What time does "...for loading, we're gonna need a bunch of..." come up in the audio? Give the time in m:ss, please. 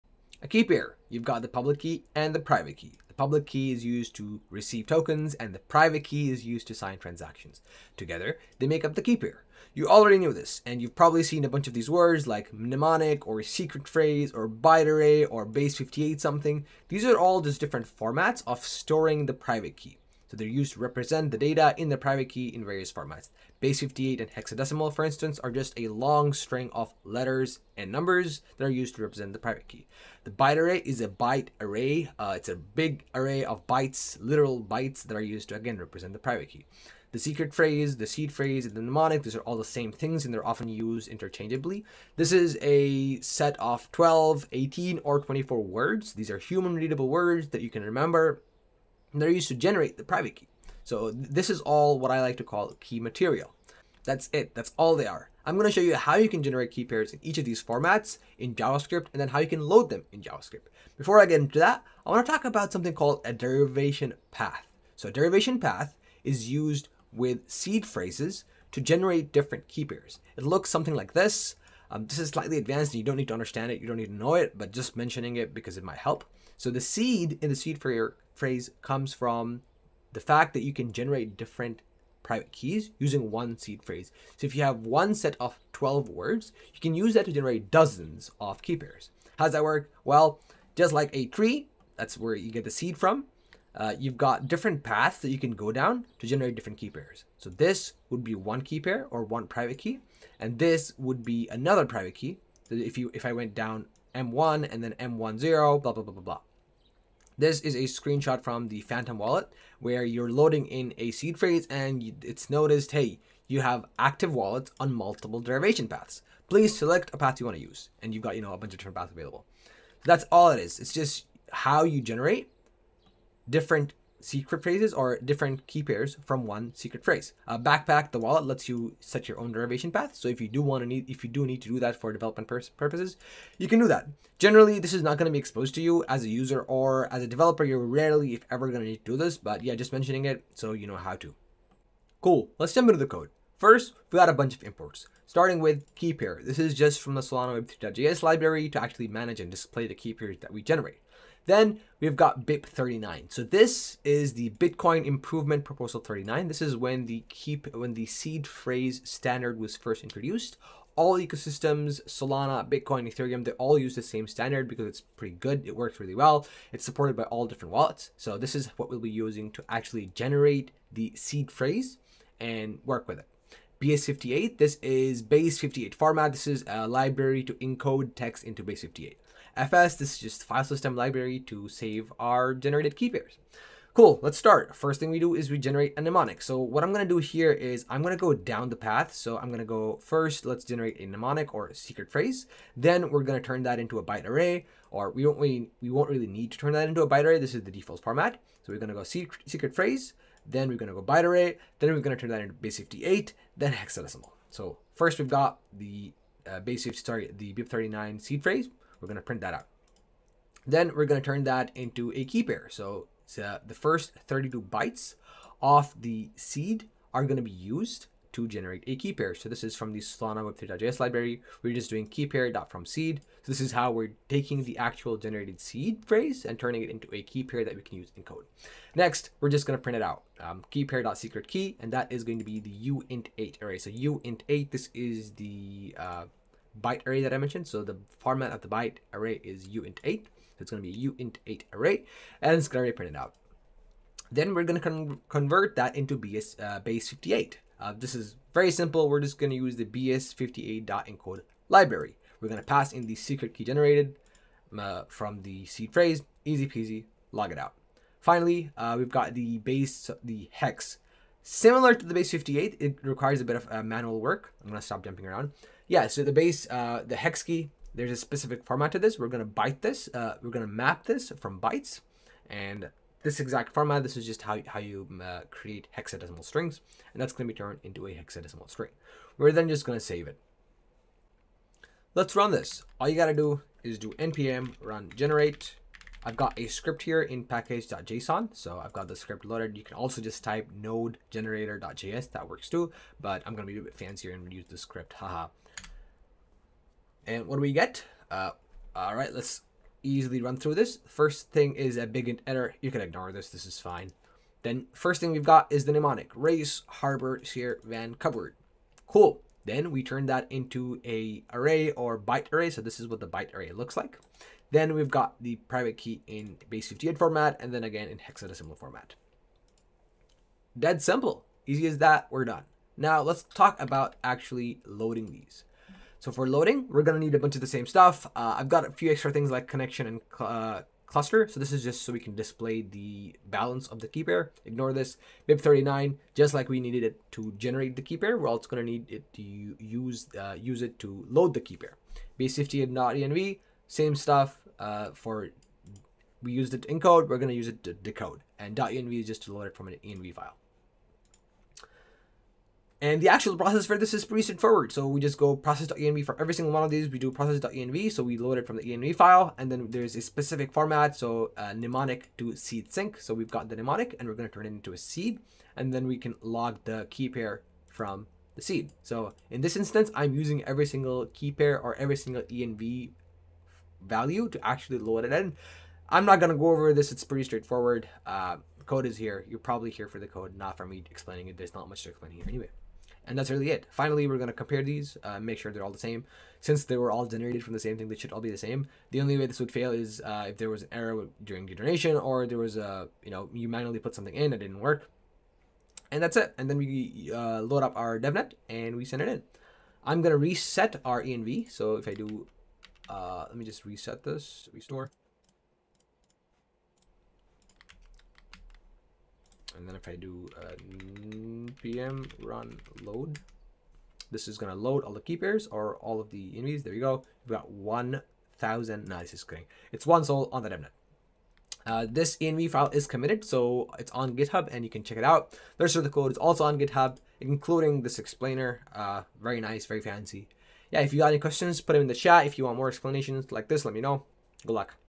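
5:26.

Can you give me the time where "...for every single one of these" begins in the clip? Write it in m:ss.
5:56.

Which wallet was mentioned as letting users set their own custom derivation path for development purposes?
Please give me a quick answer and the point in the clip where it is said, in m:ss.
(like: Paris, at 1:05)
Backpack, at 2:07.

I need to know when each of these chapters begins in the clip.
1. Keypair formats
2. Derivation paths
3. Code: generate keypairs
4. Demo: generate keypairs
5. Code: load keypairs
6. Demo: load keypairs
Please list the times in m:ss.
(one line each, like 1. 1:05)
1. 0:17
2. 1:01
3. 2:22
4. 4:41
5. 5:23
6. 6:51.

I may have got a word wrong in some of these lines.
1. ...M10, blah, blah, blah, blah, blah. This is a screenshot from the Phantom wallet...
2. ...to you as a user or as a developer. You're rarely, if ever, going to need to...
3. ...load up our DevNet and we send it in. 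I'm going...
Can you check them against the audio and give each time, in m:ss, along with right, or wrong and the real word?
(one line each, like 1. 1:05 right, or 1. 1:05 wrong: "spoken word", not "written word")
1. 1:44 right
2. 2:15 right
3. 6:37 right.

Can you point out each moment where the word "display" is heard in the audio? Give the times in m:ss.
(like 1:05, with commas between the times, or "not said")
2:29, 5:32.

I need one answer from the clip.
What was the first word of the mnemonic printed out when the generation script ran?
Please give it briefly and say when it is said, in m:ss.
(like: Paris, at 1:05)
Race, at 5:06.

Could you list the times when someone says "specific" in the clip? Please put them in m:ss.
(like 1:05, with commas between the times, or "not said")
4:28, 6:00.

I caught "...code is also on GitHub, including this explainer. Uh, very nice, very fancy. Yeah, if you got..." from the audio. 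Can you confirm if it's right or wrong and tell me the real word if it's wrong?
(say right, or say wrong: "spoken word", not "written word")
right.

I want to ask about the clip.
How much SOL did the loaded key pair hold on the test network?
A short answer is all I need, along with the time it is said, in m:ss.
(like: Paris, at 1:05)
1 SOL, at 7:00.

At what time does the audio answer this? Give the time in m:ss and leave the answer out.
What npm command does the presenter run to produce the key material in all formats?
4:44.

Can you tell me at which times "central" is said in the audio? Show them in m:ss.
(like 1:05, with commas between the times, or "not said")
not said.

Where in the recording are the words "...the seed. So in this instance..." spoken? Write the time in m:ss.
6:08.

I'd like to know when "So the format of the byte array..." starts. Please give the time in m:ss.
3:57.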